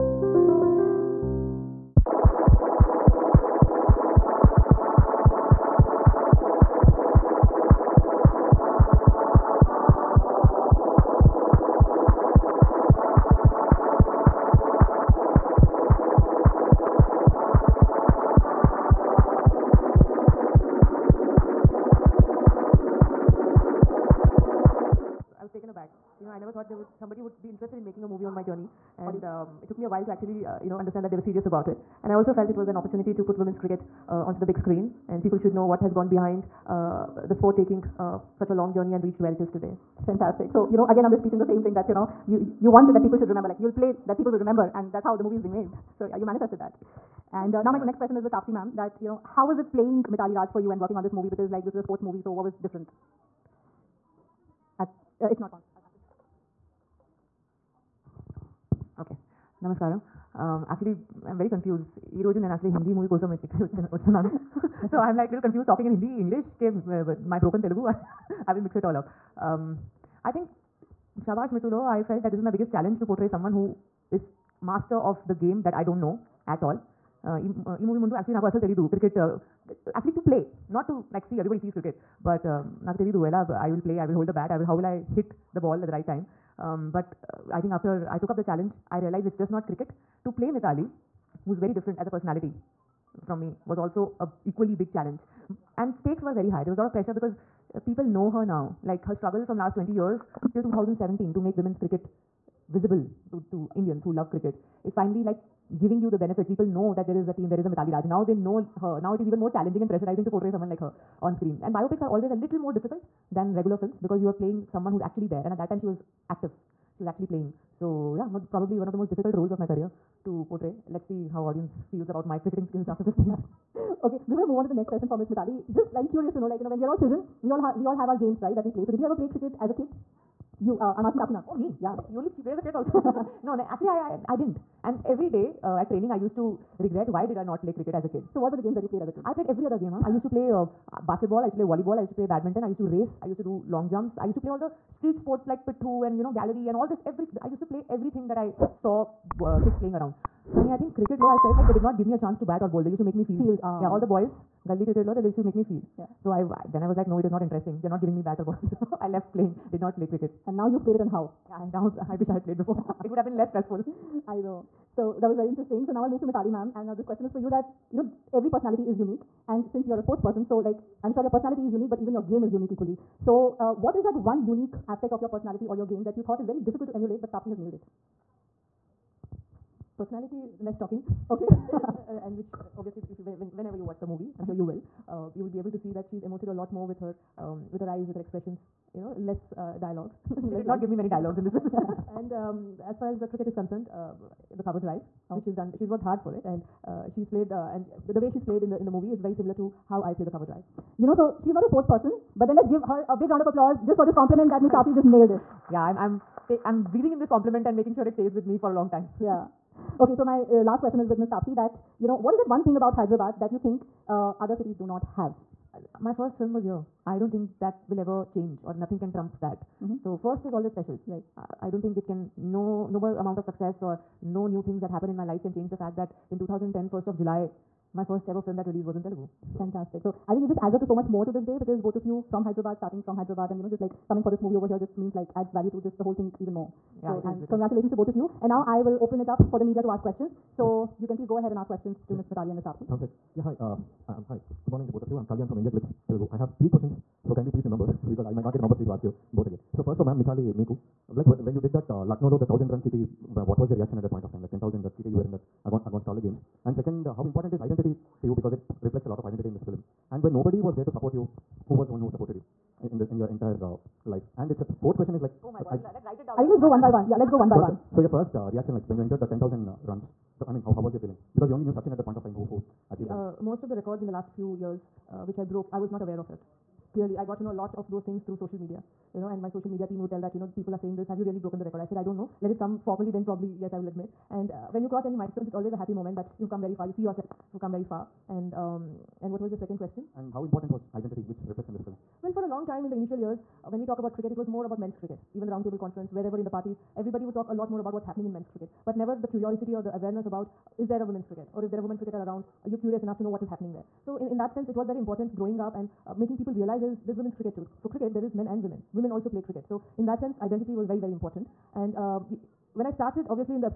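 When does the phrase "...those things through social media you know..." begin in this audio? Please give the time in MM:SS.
04:37.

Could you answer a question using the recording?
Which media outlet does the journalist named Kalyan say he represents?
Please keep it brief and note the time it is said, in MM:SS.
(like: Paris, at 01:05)
IndiaGlitz Telugu, at 04:05.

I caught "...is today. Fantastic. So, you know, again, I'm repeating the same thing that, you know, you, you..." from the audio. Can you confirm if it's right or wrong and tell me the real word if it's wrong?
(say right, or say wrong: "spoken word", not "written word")
right.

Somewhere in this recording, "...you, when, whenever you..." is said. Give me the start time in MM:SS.
03:03.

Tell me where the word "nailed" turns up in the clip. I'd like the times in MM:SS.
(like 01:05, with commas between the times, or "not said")
02:57, 03:25.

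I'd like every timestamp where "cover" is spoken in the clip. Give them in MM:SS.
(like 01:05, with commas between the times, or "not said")
03:14, 03:20.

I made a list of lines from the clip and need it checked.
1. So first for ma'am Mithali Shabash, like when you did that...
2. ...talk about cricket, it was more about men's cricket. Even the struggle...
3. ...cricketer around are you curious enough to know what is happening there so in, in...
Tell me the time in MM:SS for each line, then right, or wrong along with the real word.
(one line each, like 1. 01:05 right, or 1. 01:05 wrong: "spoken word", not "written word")
1. 04:09 wrong: "Meeku", not "Shabash"
2. 04:53 wrong: "roundtable", not "struggle"
3. 05:01 right.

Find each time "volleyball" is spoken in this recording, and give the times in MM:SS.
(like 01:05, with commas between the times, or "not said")
02:21.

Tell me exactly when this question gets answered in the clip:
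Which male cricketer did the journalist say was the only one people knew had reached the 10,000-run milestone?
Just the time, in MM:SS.
04:31.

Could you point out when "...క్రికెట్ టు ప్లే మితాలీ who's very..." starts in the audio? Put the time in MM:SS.
01:29.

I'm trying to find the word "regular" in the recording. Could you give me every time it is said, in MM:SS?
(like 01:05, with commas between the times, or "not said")
01:53.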